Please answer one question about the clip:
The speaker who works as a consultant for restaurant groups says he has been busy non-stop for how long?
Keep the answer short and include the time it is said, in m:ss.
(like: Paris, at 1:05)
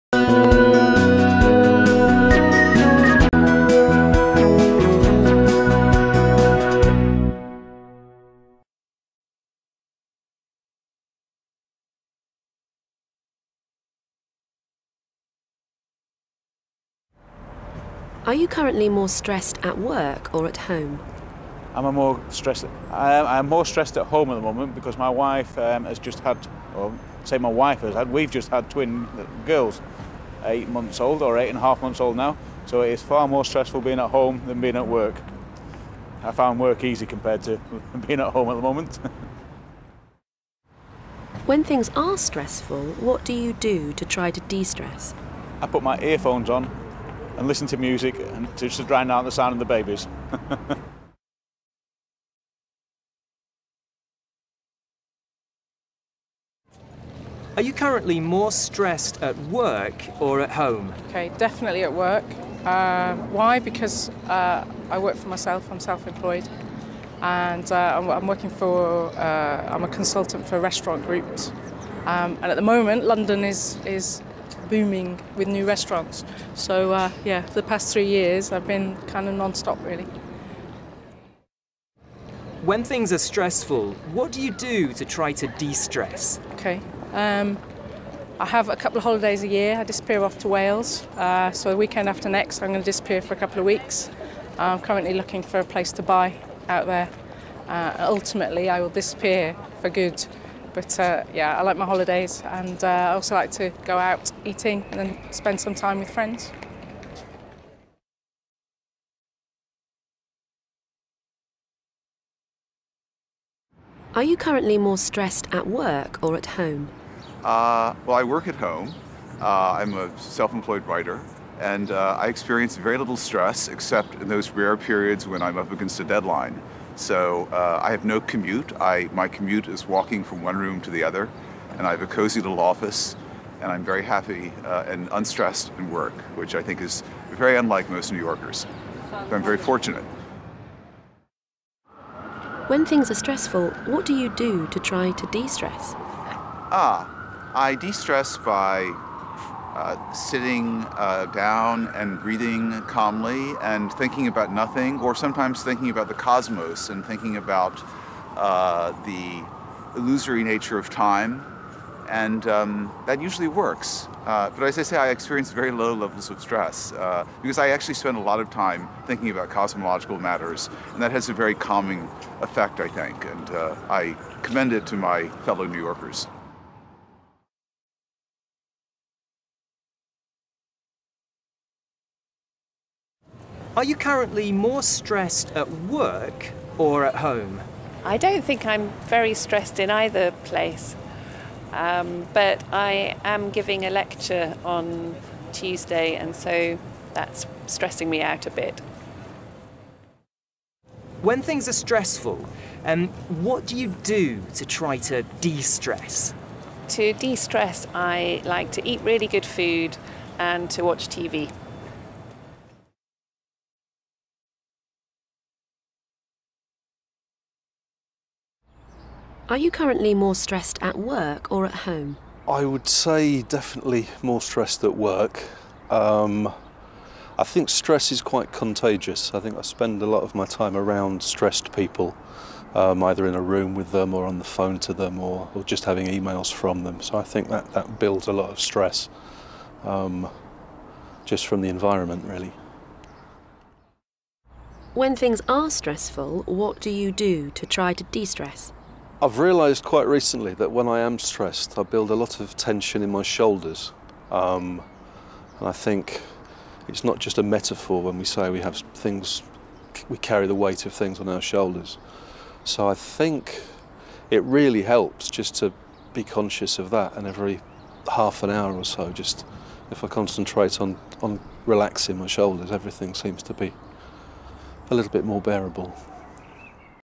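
3 years, at 1:17.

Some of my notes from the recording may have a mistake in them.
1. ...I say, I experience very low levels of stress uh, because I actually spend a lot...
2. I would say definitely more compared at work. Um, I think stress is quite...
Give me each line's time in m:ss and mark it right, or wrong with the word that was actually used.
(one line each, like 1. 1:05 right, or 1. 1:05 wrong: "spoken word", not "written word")
1. 2:44 right
2. 3:42 wrong: "stressed", not "compared".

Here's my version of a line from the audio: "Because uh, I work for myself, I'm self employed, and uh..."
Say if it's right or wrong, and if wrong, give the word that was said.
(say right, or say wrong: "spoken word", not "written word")
right.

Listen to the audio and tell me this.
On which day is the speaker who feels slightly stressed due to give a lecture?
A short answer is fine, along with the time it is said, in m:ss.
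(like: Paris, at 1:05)
Tuesday, at 3:15.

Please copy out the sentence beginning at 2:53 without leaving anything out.
And I commend it to my fellow New Yorkers.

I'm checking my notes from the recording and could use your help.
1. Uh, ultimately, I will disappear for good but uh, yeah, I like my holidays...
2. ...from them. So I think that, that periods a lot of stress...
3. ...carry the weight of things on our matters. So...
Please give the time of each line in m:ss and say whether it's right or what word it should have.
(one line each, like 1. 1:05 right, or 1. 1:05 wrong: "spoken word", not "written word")
1. 1:37 right
2. 3:56 wrong: "builds", not "periods"
3. 4:20 wrong: "shoulders", not "matters".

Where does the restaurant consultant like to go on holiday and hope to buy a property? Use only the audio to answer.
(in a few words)
Wales.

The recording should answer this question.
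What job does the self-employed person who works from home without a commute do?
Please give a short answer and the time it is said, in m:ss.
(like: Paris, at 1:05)
Writer, at 2:00.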